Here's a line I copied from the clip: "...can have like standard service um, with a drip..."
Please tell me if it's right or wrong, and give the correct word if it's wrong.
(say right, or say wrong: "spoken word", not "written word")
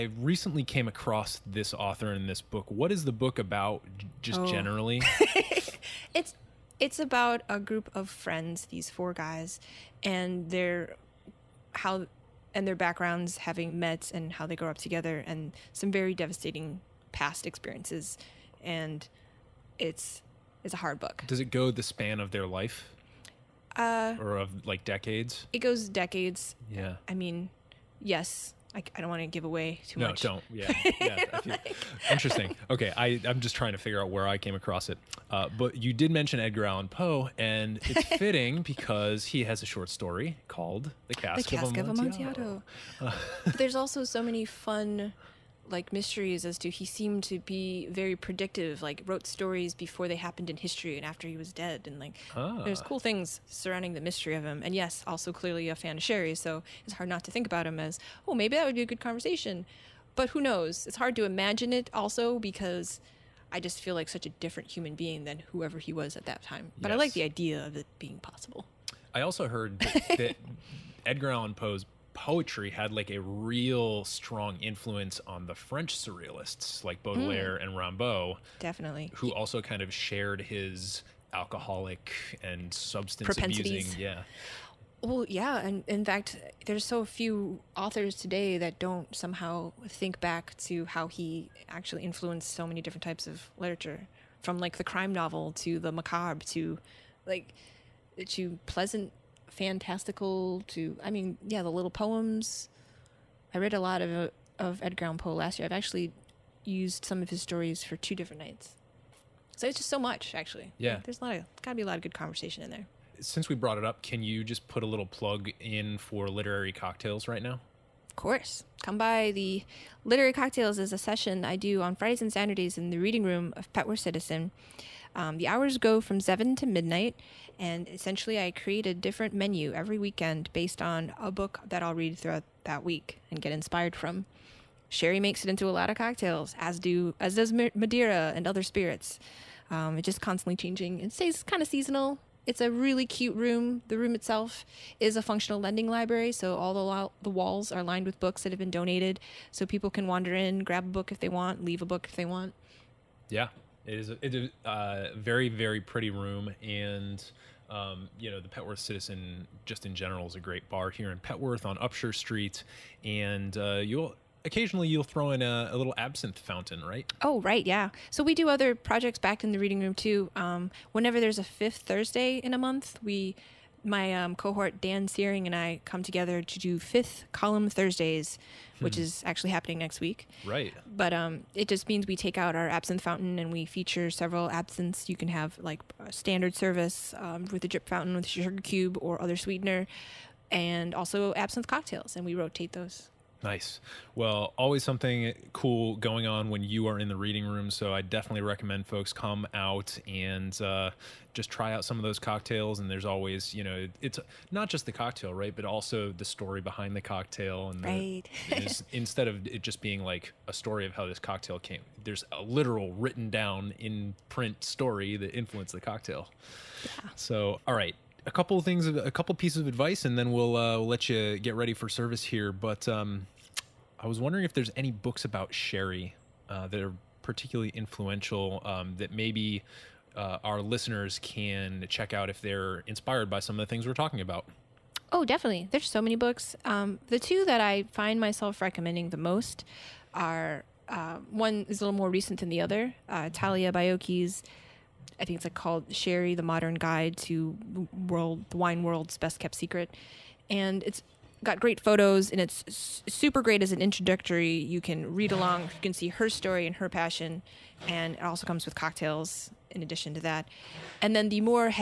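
right.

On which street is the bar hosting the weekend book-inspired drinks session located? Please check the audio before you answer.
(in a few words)
Upshur Street.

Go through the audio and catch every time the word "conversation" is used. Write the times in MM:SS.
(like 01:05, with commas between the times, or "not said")
00:59, 01:52.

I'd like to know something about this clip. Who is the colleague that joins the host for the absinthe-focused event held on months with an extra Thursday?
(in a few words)
Dan Searing.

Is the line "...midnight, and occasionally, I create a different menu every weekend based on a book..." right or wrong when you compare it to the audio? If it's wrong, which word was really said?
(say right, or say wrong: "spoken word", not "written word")
wrong: "essentially", not "occasionally".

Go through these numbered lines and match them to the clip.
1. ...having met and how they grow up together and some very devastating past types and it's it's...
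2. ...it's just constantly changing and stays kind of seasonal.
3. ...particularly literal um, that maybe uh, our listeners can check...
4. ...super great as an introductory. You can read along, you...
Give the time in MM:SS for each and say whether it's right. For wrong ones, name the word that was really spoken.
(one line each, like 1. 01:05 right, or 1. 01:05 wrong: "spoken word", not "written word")
1. 00:13 wrong: "experiences", not "types"
2. 02:19 right
3. 03:47 wrong: "influential", not "literal"
4. 04:13 right.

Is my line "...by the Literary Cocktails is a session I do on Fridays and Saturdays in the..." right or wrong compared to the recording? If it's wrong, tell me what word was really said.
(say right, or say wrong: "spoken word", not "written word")
right.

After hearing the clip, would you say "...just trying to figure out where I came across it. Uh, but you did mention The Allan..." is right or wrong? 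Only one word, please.
wrong.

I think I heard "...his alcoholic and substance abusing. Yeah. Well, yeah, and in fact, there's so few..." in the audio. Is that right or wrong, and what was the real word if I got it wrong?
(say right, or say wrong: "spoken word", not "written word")
right.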